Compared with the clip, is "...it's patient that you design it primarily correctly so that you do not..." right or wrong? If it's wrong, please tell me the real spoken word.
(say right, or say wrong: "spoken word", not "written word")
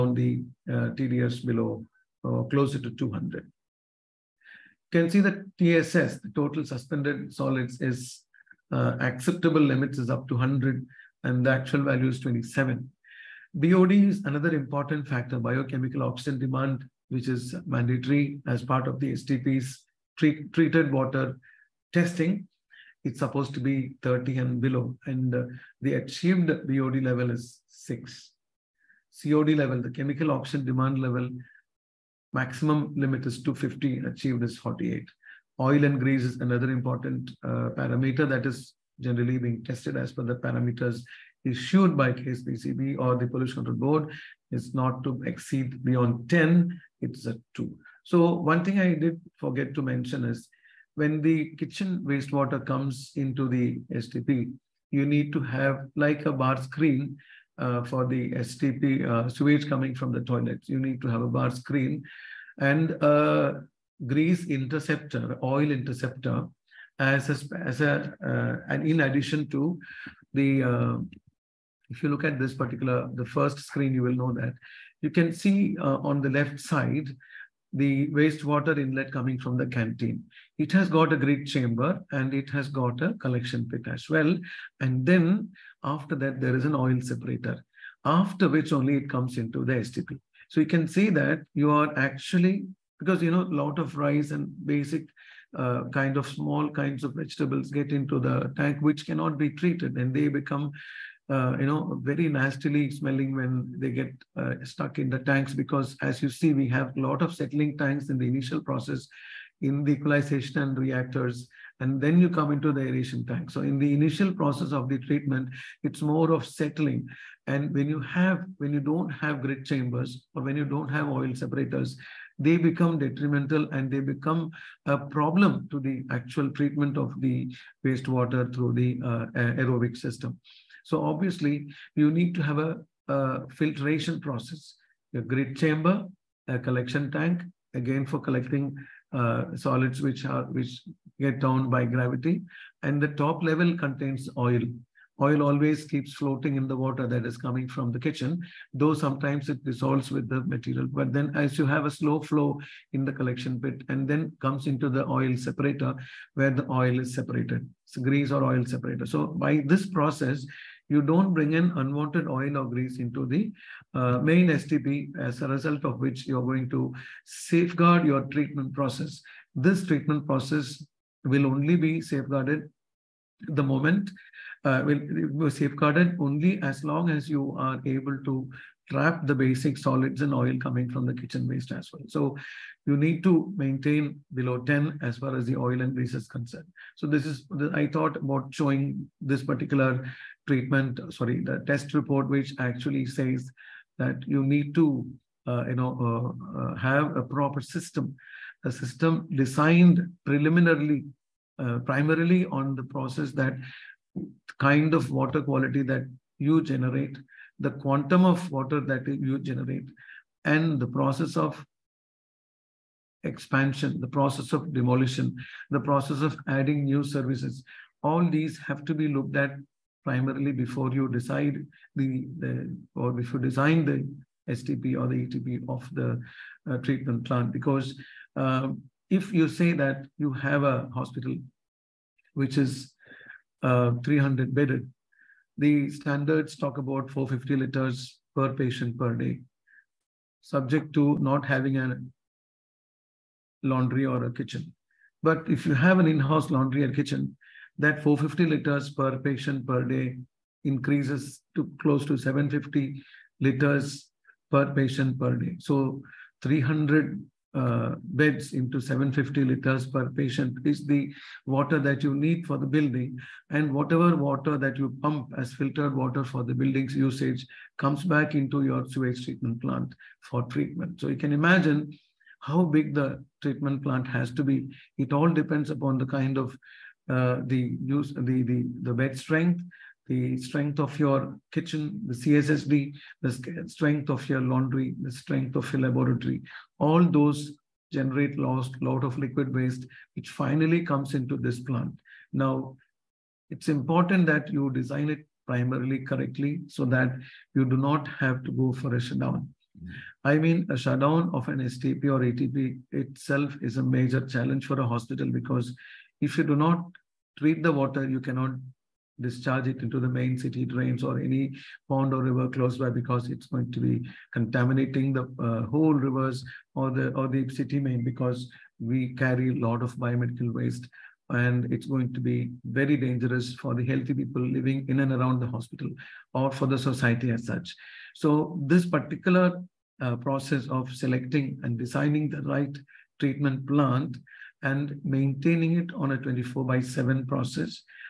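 wrong: "important", not "patient".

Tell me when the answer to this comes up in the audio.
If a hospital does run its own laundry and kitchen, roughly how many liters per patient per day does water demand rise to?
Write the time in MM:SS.
04:12.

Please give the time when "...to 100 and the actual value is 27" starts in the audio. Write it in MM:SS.
00:10.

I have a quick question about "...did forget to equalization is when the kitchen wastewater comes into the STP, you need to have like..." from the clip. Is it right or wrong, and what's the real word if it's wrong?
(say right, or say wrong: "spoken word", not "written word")
wrong: "mention", not "equalization".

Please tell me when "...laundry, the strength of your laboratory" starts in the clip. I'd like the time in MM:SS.
04:44.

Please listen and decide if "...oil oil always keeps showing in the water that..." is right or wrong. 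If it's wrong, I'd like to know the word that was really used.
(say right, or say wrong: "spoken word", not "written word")
wrong: "floating", not "showing".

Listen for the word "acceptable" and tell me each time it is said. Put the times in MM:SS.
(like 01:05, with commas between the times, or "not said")
00:08.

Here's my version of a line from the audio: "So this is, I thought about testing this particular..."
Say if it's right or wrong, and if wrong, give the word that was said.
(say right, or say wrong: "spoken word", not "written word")
wrong: "showing", not "testing".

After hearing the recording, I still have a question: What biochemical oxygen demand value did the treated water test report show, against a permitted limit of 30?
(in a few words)
6.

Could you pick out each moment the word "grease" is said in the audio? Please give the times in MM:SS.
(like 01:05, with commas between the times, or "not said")
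00:35, 01:04, 02:37, 02:42, 03:05.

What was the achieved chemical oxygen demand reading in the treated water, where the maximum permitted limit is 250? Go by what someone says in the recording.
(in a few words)
48.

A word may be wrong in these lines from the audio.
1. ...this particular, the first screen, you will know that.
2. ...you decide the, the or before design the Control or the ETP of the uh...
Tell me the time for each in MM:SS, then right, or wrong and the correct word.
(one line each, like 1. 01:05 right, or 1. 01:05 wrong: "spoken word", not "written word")
1. 01:12 right
2. 03:40 wrong: "STP", not "Control".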